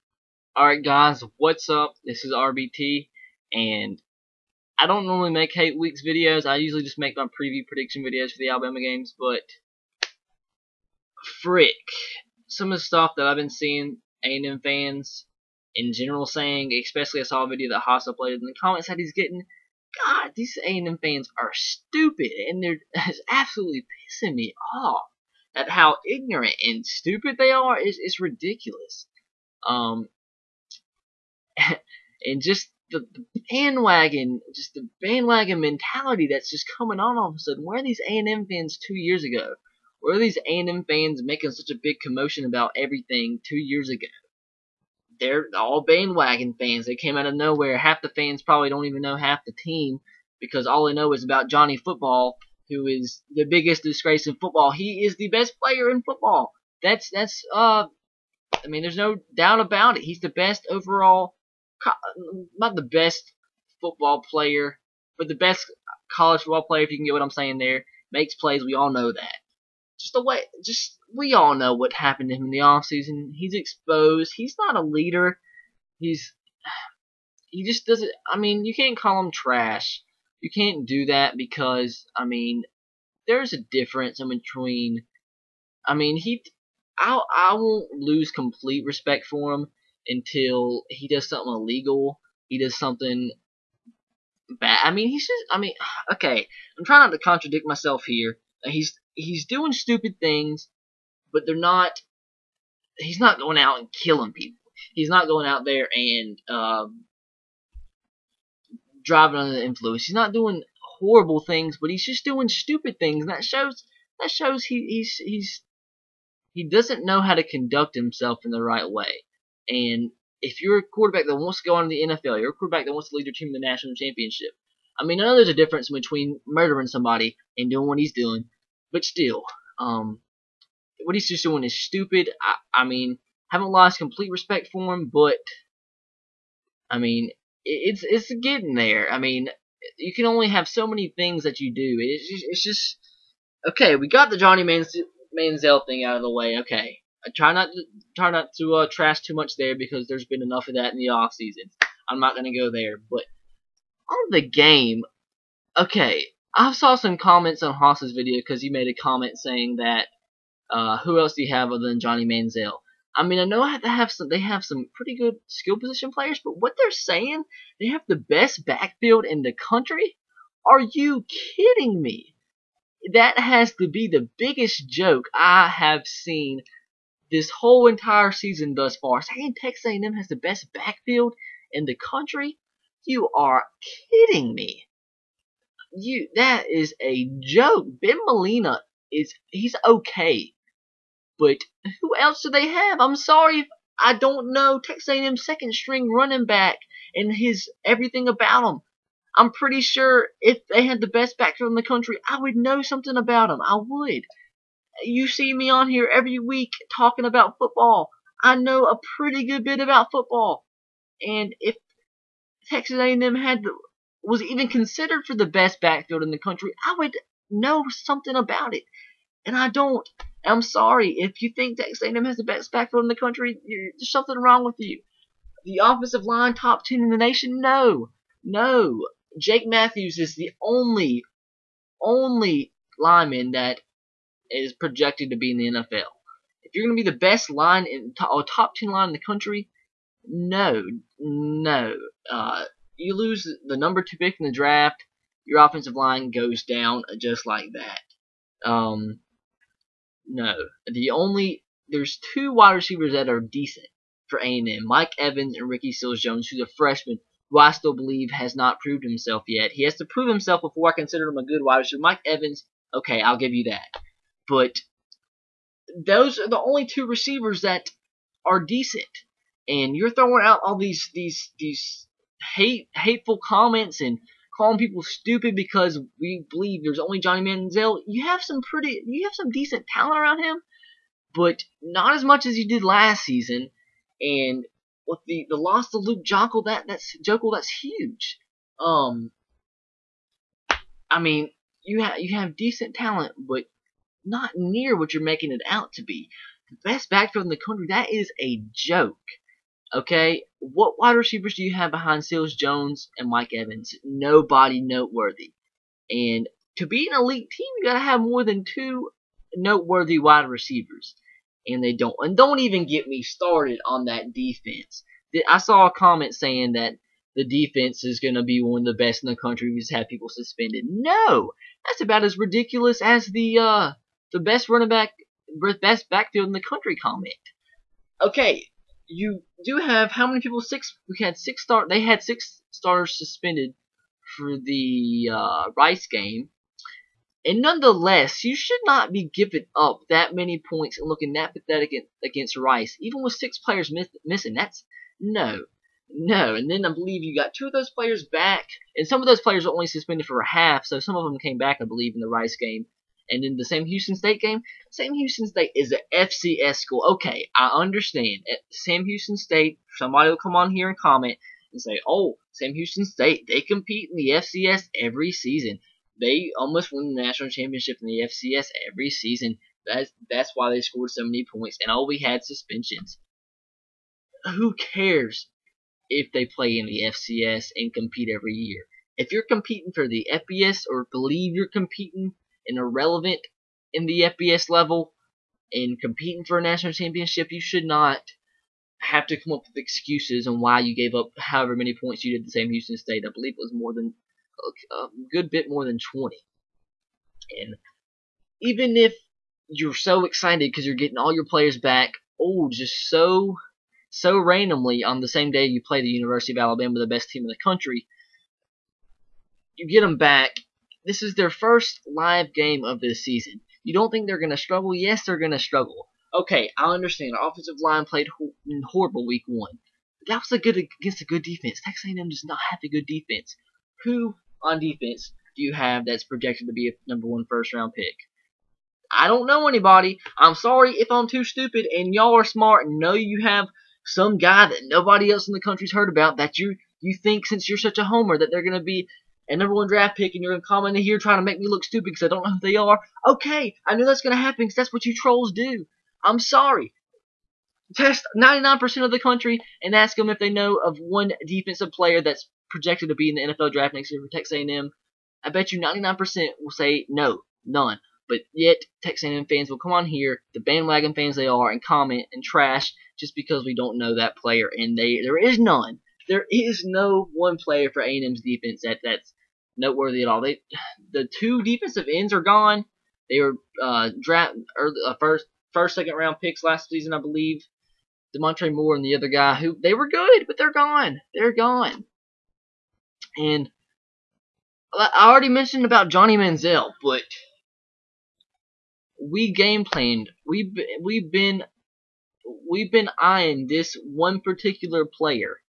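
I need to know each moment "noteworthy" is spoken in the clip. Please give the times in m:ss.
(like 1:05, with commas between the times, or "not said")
5:04, 5:09, 7:49.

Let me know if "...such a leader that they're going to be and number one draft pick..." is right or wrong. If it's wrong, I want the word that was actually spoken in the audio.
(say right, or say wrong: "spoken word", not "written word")
wrong: "homer", not "leader".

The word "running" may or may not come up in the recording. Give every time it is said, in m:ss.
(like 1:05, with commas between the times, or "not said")
3:16, 5:24.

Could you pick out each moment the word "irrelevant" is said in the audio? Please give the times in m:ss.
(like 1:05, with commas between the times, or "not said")
6:22.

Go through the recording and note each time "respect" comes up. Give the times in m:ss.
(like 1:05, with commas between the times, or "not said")
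1:28, 2:14.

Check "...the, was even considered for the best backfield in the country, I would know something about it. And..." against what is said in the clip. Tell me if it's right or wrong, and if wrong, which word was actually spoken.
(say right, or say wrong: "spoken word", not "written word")
right.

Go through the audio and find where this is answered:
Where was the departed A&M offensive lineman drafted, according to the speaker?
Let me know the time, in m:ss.
4:03.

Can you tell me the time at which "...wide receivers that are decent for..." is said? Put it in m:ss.
4:12.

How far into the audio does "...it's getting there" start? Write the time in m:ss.
2:18.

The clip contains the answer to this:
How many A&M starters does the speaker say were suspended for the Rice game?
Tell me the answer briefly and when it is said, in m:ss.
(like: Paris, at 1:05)
6, at 5:32.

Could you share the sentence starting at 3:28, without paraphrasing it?
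I know a pretty good bit about football.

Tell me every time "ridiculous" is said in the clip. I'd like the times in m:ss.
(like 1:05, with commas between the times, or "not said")
0:28, 5:22.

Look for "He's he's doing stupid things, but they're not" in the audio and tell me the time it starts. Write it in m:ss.
1:38.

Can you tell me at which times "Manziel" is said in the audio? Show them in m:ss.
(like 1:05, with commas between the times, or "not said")
2:24, 2:42, 4:37, 8:06.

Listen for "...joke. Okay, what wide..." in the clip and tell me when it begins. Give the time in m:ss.
4:58.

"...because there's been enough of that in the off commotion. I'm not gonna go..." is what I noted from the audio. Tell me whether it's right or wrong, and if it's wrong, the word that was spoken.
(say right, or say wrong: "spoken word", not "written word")
wrong: "season", not "commotion".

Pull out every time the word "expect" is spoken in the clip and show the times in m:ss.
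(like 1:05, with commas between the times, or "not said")
not said.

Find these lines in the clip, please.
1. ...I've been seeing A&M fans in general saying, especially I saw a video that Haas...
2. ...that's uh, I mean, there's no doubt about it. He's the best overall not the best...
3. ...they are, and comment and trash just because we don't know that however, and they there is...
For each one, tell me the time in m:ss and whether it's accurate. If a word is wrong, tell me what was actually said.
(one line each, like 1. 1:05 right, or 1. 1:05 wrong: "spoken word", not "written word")
1. 0:13 right
2. 0:57 right
3. 7:41 wrong: "player", not "however".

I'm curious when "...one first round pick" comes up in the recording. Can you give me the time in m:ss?
7:07.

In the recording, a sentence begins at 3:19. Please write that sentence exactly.
I'm pretty sure if they had the best backfield in the country, I would know something about him.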